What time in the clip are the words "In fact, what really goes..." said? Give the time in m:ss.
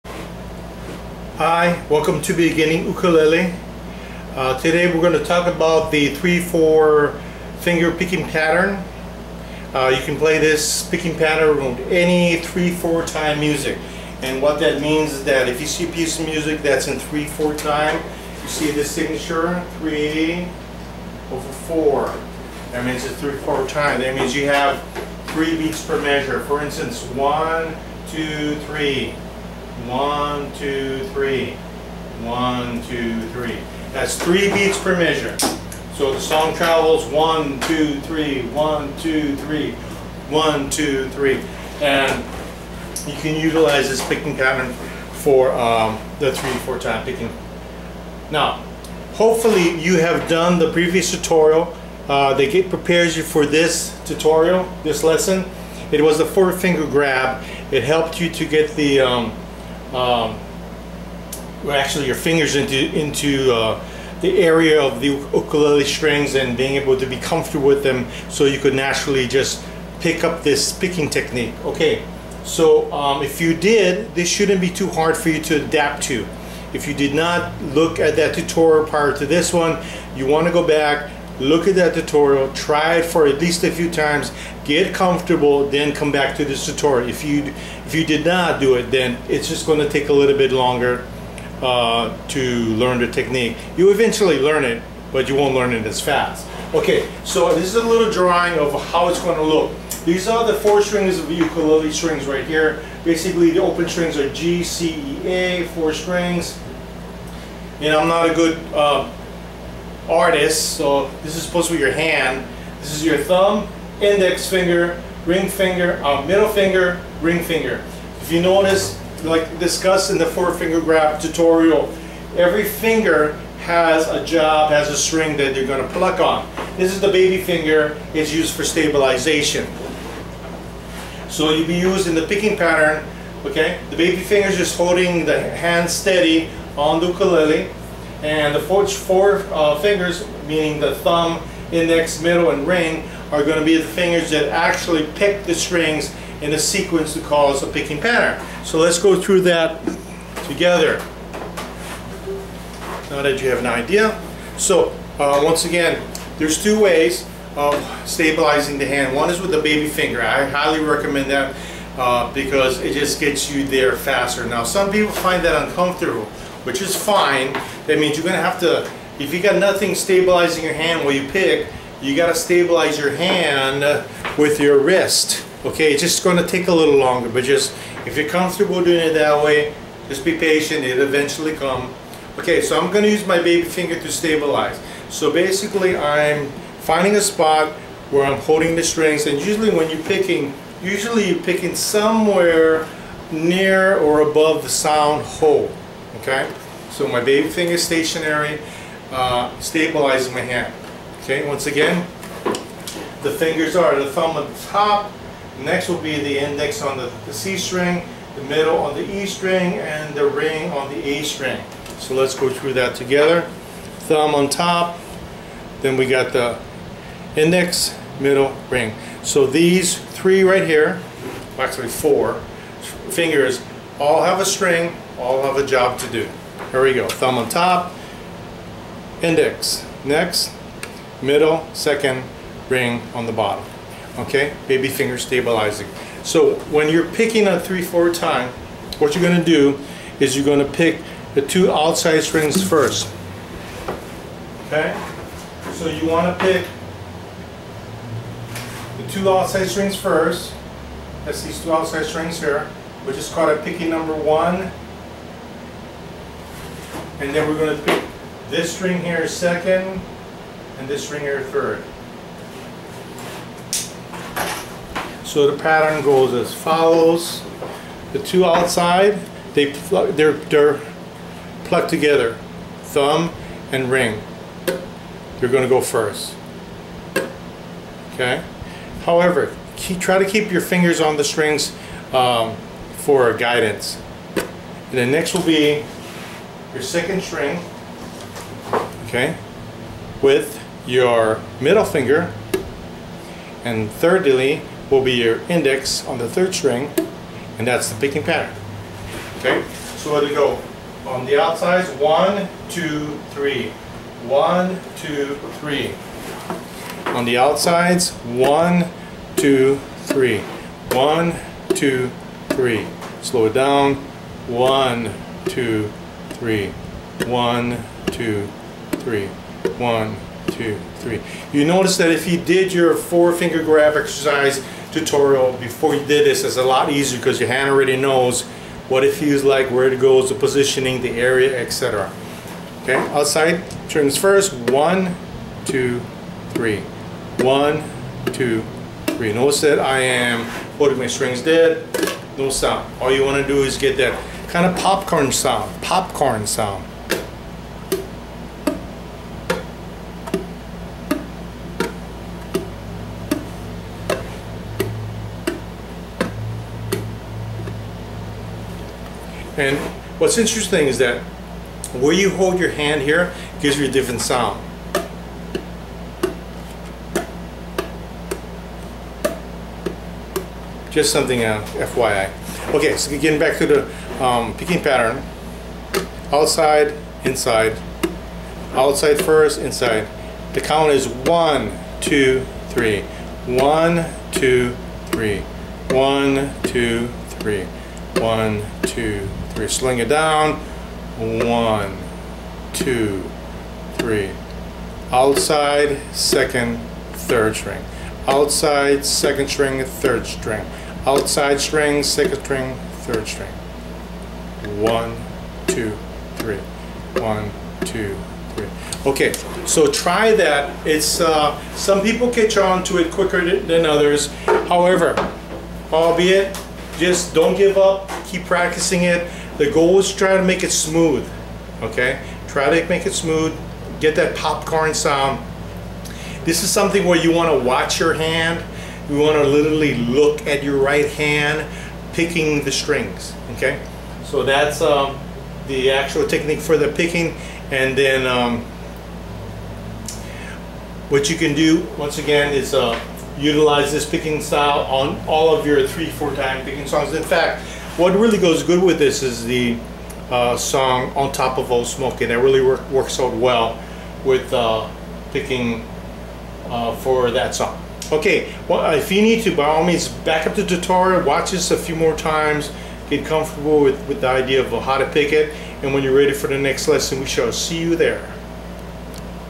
7:27.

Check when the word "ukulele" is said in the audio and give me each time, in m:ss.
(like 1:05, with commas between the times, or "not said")
0:02, 1:05, 1:41, 2:17.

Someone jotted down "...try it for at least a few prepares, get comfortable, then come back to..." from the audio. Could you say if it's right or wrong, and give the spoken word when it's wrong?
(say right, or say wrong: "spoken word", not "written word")
wrong: "times", not "prepares".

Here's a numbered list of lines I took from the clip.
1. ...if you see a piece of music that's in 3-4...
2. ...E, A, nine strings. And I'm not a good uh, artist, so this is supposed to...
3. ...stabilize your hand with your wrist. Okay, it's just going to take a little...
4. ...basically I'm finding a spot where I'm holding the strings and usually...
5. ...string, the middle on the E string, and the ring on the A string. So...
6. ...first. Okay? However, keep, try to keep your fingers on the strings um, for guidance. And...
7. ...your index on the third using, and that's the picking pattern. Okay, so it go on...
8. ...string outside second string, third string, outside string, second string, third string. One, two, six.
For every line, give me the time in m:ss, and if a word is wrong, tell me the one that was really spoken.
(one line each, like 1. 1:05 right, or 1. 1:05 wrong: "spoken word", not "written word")
1. 0:15 right
2. 1:45 wrong: "four", not "nine"
3. 2:52 right
4. 3:05 right
5. 3:27 right
6. 4:35 right
7. 4:55 wrong: "string", not "using"
8. 6:37 wrong: "three", not "six".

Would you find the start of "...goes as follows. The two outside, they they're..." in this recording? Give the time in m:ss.
4:26.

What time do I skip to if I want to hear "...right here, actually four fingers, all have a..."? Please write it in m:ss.
3:40.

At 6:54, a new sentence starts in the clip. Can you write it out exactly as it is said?
However, albeit, just don't give up.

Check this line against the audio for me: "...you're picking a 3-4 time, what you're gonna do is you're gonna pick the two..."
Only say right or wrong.
right.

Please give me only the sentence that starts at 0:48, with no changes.
Now, hopefully you have done the previous tutorial.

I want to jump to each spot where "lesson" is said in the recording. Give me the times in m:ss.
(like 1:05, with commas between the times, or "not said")
0:55, 7:46.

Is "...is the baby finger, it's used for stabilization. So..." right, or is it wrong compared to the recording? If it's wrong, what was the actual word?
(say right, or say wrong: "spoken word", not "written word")
right.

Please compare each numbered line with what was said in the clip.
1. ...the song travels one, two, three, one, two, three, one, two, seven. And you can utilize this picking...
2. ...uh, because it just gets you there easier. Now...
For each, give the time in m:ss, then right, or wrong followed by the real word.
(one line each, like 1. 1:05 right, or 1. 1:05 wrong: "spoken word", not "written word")
1. 0:36 wrong: "three", not "seven"
2. 2:41 wrong: "faster", not "easier".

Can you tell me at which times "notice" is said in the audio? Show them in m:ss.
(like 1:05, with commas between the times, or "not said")
1:58, 5:21, 5:39.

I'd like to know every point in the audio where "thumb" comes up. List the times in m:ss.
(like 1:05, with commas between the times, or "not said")
1:53, 2:20, 3:24, 3:34, 3:47, 4:32.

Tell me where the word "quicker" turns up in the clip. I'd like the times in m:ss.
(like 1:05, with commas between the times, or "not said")
6:53.